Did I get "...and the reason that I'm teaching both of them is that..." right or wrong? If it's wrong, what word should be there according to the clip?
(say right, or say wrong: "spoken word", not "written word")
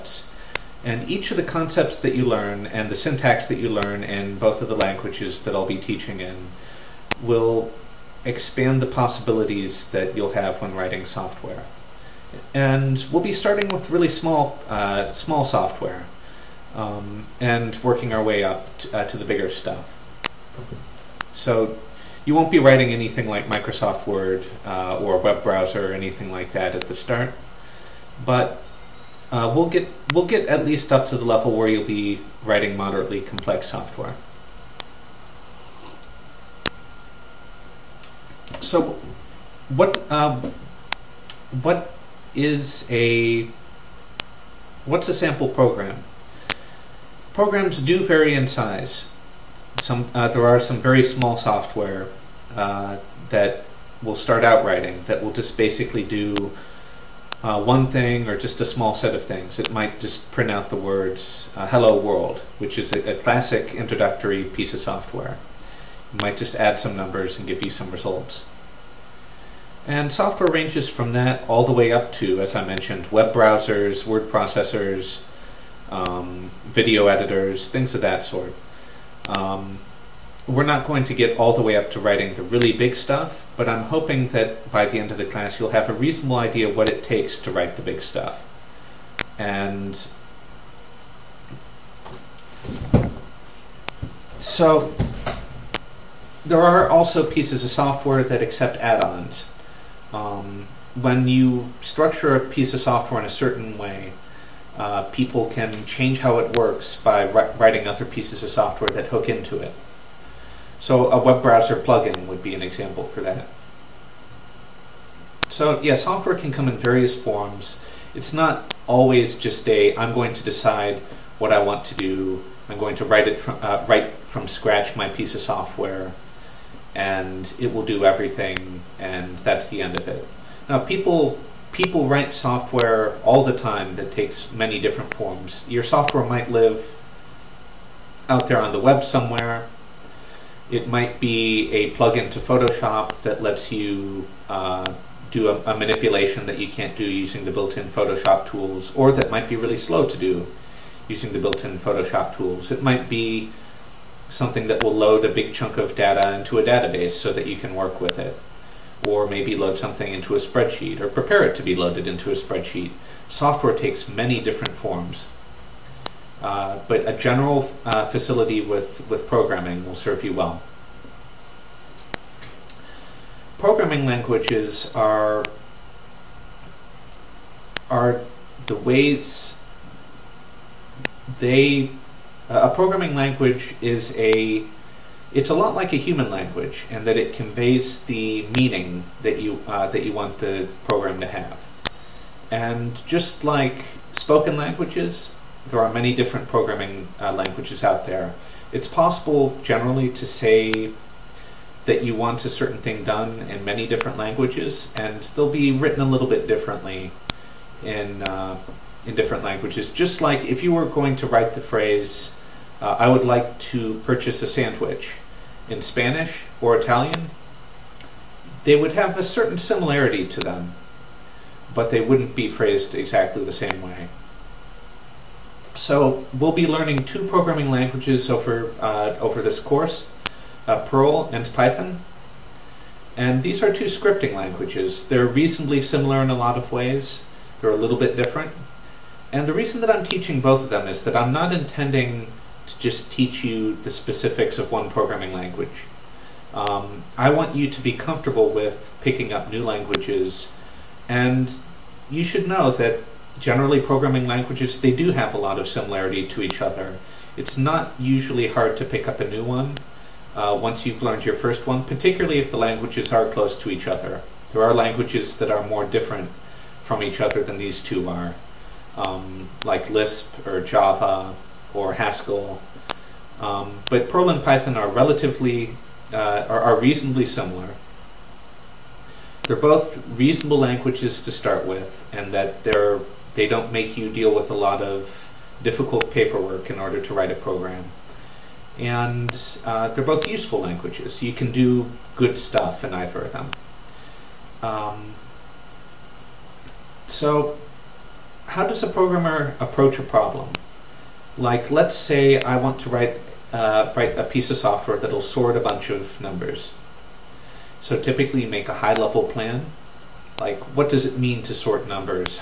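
right.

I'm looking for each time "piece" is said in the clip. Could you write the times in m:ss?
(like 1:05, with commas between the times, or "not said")
1:04, 1:37, 1:42, 1:48, 2:05, 5:04.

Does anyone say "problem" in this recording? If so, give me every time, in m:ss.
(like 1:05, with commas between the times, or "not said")
5:00.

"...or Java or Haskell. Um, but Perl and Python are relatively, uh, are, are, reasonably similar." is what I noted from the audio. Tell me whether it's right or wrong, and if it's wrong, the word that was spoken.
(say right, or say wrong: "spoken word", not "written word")
right.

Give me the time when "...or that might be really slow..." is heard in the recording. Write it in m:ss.
2:28.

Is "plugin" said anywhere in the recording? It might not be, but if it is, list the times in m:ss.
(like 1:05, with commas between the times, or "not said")
1:51, 2:21.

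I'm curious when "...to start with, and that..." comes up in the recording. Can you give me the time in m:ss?
4:41.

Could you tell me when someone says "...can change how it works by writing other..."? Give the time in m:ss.
1:45.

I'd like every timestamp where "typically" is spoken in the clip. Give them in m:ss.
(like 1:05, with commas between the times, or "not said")
5:07.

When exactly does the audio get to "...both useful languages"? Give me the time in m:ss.
4:50.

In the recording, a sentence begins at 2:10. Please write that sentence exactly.
Now, people people write software all the time that takes many different forms.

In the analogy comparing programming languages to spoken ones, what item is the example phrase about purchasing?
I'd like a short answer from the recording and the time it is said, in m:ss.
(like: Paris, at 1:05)
a sandwich, at 3:34.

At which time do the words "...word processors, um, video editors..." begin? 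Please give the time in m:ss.
1:14.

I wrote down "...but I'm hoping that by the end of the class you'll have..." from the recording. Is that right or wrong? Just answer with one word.
right.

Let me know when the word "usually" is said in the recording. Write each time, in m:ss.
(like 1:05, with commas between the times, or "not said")
4:17.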